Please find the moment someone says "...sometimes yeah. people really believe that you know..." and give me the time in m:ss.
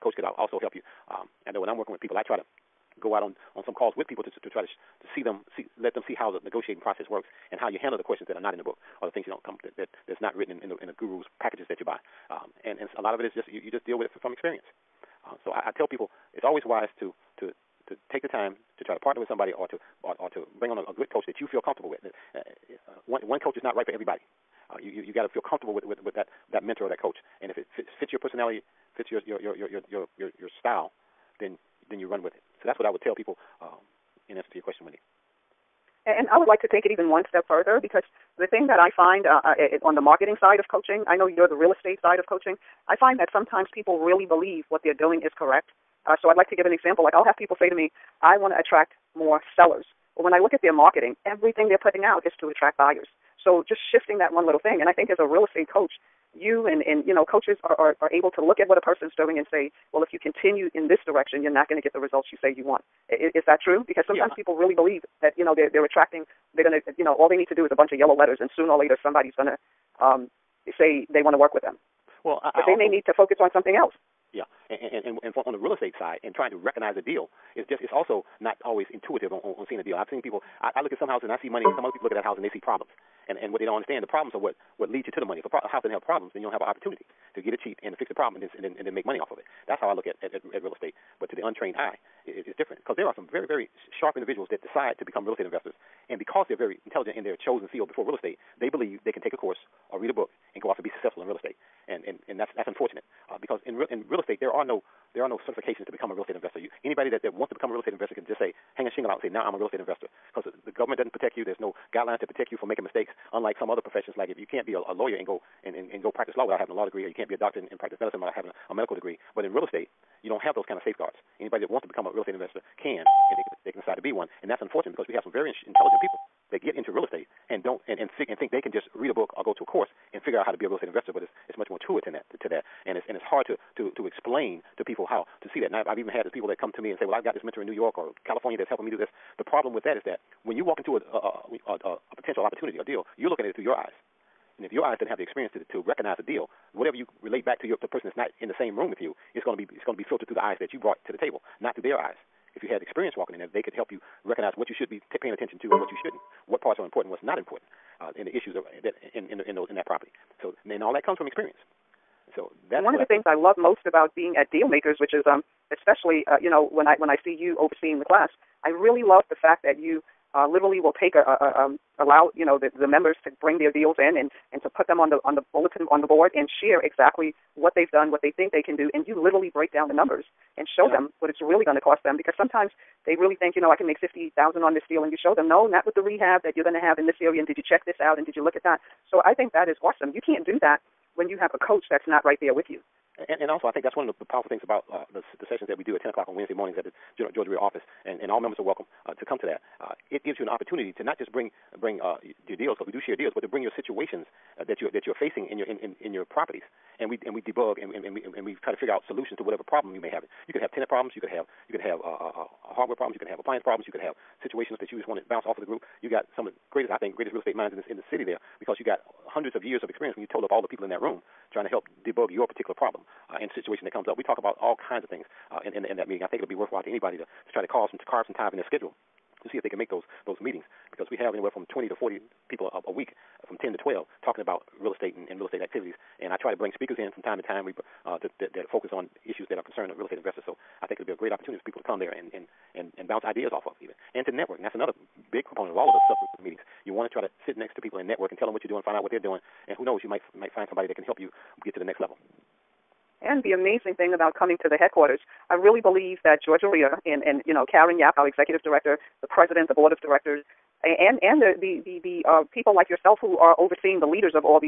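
1:04.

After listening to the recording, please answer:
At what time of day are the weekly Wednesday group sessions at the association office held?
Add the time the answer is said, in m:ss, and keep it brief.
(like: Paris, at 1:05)
10 o'clock, at 3:16.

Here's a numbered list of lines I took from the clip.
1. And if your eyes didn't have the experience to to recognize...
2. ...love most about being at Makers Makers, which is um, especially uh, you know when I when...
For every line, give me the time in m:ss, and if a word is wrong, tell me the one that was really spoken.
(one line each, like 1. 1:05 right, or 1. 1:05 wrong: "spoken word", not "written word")
1. 2:24 right
2. 2:43 wrong: "Deal", not "Makers".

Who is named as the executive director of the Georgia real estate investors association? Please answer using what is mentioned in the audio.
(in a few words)
Karen Yaap.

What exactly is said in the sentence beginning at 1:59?
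But in real estate, you don't have those kind of safeguards.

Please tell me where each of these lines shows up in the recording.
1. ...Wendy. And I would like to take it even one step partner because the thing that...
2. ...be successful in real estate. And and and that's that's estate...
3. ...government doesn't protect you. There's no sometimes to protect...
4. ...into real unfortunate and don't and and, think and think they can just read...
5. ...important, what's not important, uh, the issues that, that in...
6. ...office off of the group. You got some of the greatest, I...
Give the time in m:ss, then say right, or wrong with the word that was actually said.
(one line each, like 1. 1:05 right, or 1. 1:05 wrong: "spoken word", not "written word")
1. 0:34 wrong: "further", not "partner"
2. 1:40 wrong: "unfortunate", not "estate"
3. 1:50 wrong: "guidelines", not "sometimes"
4. 2:06 wrong: "estate", not "unfortunate"
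5. 2:36 right
6. 3:35 wrong: "bounce", not "office".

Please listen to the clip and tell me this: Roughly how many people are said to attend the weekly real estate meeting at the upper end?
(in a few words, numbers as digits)
40.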